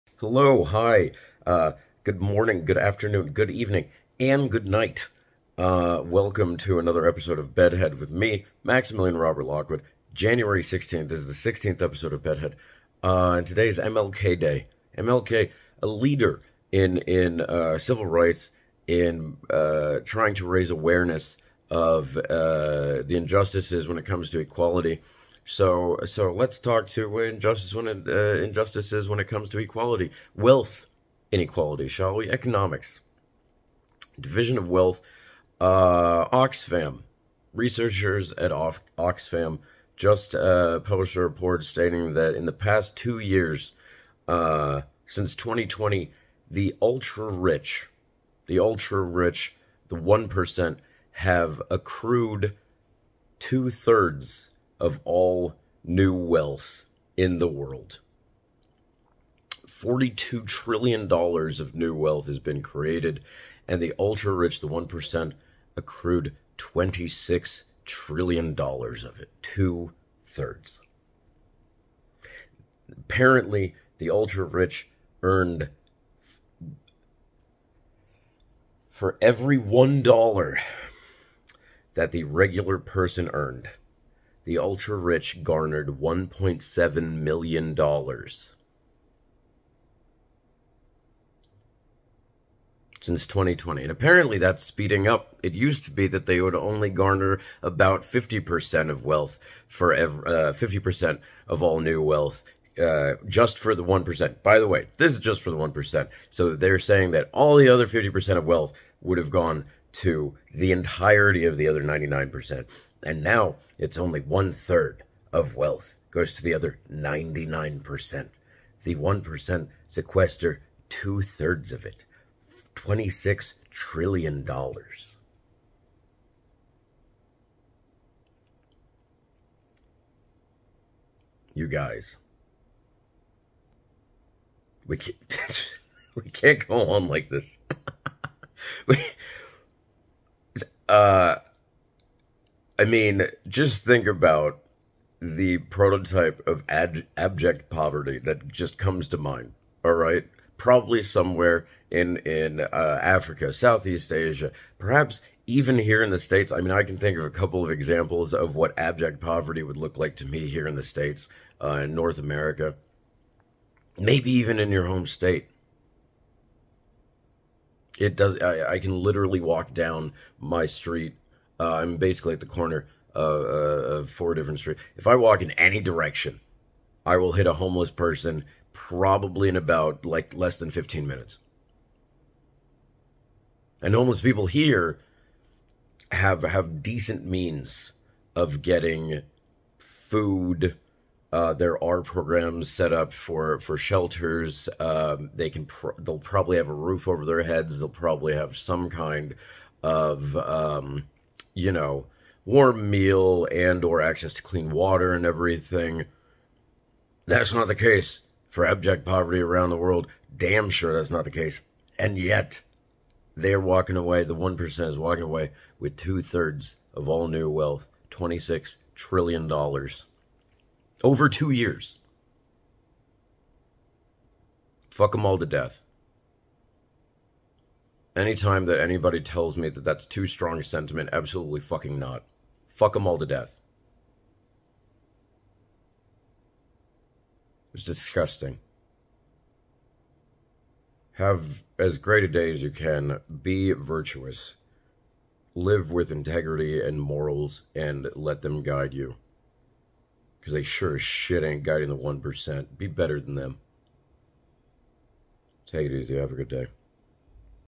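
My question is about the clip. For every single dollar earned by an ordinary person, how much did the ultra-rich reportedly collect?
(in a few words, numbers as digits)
$1.7 million.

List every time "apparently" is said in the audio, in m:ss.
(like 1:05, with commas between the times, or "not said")
1:12, 1:33.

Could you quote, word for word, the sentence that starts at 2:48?
I, I can literally walk down my street uh, I'm basically at the corner of, uh, uh, of four different streets.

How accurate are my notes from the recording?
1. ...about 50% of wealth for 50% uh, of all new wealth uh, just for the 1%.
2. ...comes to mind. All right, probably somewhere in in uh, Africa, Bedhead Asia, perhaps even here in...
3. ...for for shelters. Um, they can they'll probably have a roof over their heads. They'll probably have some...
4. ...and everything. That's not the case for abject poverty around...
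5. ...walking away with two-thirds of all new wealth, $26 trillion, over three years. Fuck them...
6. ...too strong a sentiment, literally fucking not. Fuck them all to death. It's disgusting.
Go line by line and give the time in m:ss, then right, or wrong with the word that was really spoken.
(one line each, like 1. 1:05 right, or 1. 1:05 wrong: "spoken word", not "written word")
1. 1:37 right
2. 2:28 wrong: "Southeast", not "Bedhead"
3. 3:13 right
4. 3:25 right
5. 3:34 wrong: "two", not "three"
6. 3:50 wrong: "absolutely", not "literally".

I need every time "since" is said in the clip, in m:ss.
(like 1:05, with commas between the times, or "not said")
0:45, 1:33.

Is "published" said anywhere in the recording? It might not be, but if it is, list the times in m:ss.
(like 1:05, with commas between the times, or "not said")
0:40.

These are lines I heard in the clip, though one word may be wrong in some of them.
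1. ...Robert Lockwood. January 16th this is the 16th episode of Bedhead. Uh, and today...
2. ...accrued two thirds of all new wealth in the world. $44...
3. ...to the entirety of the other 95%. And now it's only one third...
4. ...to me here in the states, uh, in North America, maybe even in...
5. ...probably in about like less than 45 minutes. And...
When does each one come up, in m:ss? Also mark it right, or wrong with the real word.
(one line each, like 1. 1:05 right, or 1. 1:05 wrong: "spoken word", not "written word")
1. 0:09 right
2. 0:51 wrong: "42", not "44"
3. 1:49 wrong: "99", not "95"
4. 2:40 right
5. 2:58 wrong: "15", not "45".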